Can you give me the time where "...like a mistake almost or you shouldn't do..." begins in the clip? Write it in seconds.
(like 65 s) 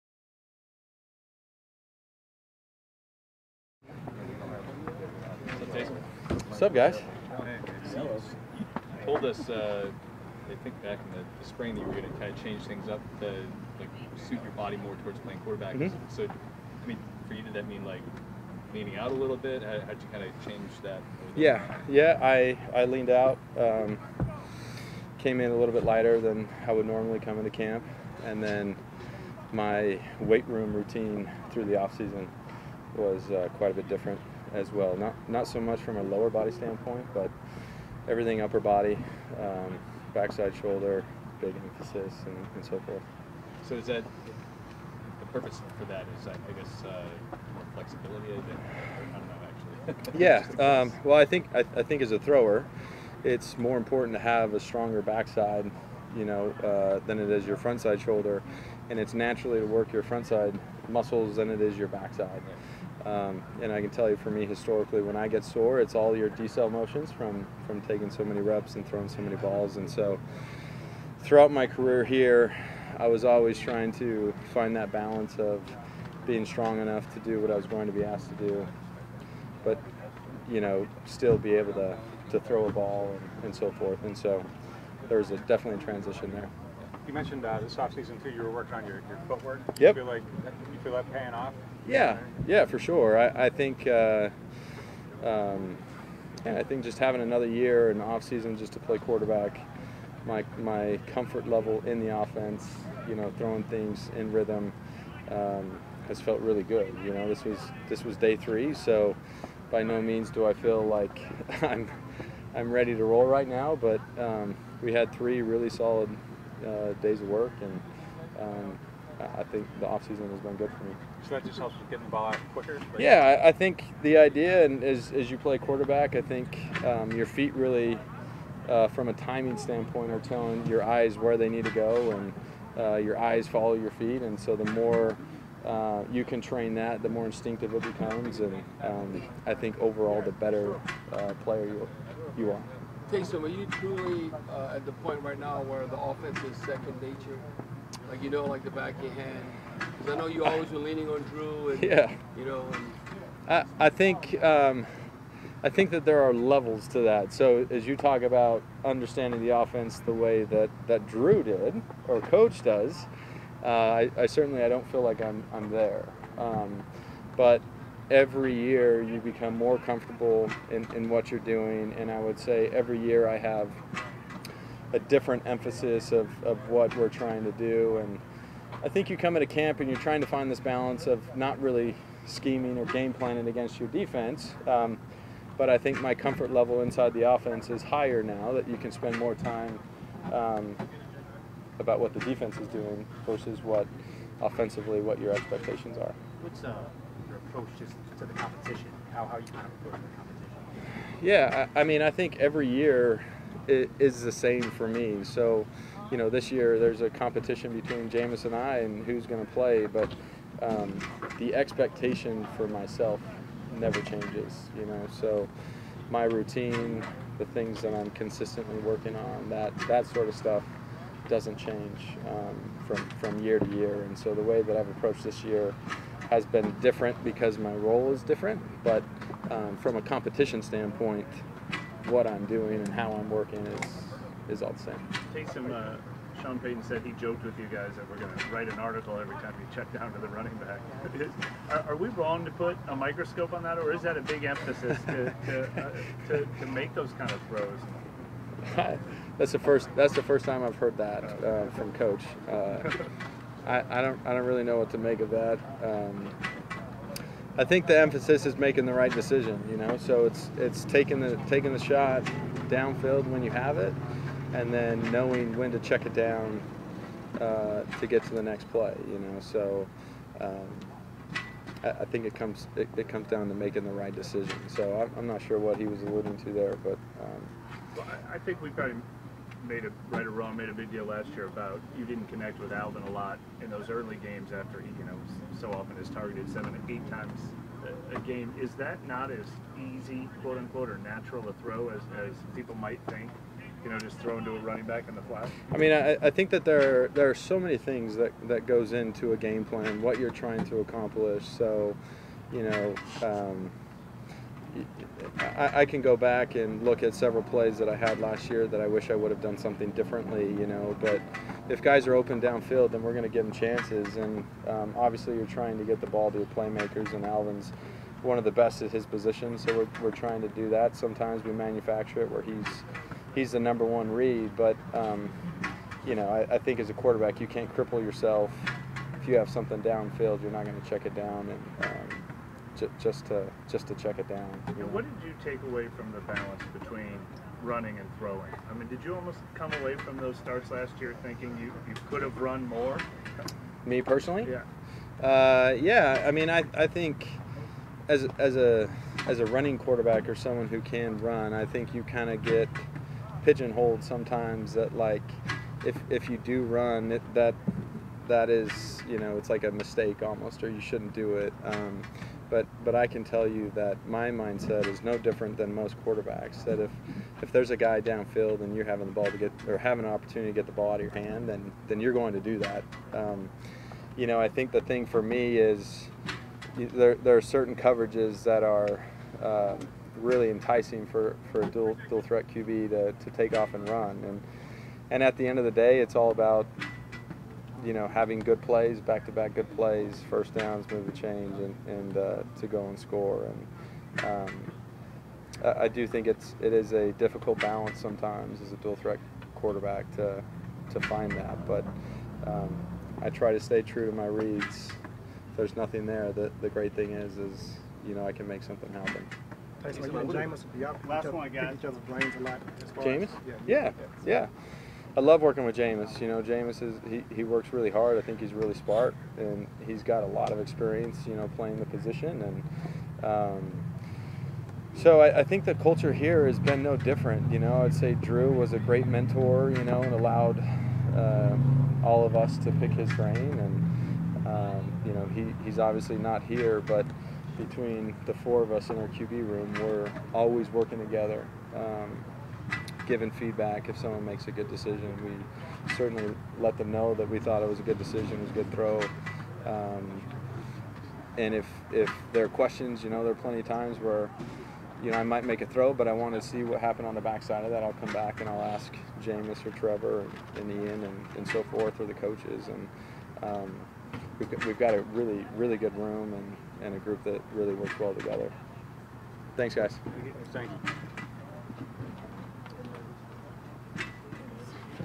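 359 s.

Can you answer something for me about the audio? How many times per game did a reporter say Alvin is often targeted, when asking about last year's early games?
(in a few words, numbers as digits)
7 to 8.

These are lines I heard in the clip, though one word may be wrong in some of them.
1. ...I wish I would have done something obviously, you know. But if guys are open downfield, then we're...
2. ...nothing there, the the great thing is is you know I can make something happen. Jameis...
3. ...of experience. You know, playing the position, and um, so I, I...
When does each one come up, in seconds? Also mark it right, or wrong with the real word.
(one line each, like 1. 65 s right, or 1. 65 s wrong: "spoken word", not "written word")
1. 308 s wrong: "differently", not "obviously"
2. 405 s right
3. 420 s right.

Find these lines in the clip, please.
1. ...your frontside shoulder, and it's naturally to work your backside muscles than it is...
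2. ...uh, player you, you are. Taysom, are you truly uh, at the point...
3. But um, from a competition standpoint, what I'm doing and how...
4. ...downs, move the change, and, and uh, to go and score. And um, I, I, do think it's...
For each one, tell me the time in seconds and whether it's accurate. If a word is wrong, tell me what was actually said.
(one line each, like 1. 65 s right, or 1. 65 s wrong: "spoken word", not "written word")
1. 57 s wrong: "frontside", not "backside"
2. 141 s right
3. 228 s right
4. 390 s right.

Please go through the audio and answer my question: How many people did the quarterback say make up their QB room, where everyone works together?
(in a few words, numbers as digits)
4.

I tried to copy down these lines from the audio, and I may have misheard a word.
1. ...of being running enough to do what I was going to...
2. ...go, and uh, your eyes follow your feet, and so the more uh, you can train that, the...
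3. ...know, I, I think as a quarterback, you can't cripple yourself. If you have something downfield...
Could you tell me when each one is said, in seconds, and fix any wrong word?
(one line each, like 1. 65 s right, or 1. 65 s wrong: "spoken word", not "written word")
1. 75 s wrong: "strong", not "running"
2. 131 s right
3. 326 s right.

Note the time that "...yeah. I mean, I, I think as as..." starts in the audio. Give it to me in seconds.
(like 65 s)
345 s.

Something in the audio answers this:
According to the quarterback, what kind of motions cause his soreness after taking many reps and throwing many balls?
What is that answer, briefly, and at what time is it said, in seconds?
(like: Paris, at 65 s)
Decel motions, at 66 s.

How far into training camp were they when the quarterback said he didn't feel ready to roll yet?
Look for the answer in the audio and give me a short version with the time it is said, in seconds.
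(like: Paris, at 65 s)
Day 3, at 108 s.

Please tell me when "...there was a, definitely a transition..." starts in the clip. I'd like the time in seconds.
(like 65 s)
85 s.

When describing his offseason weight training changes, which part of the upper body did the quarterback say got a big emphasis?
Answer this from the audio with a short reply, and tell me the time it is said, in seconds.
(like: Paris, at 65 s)
Backside shoulder, at 40 s.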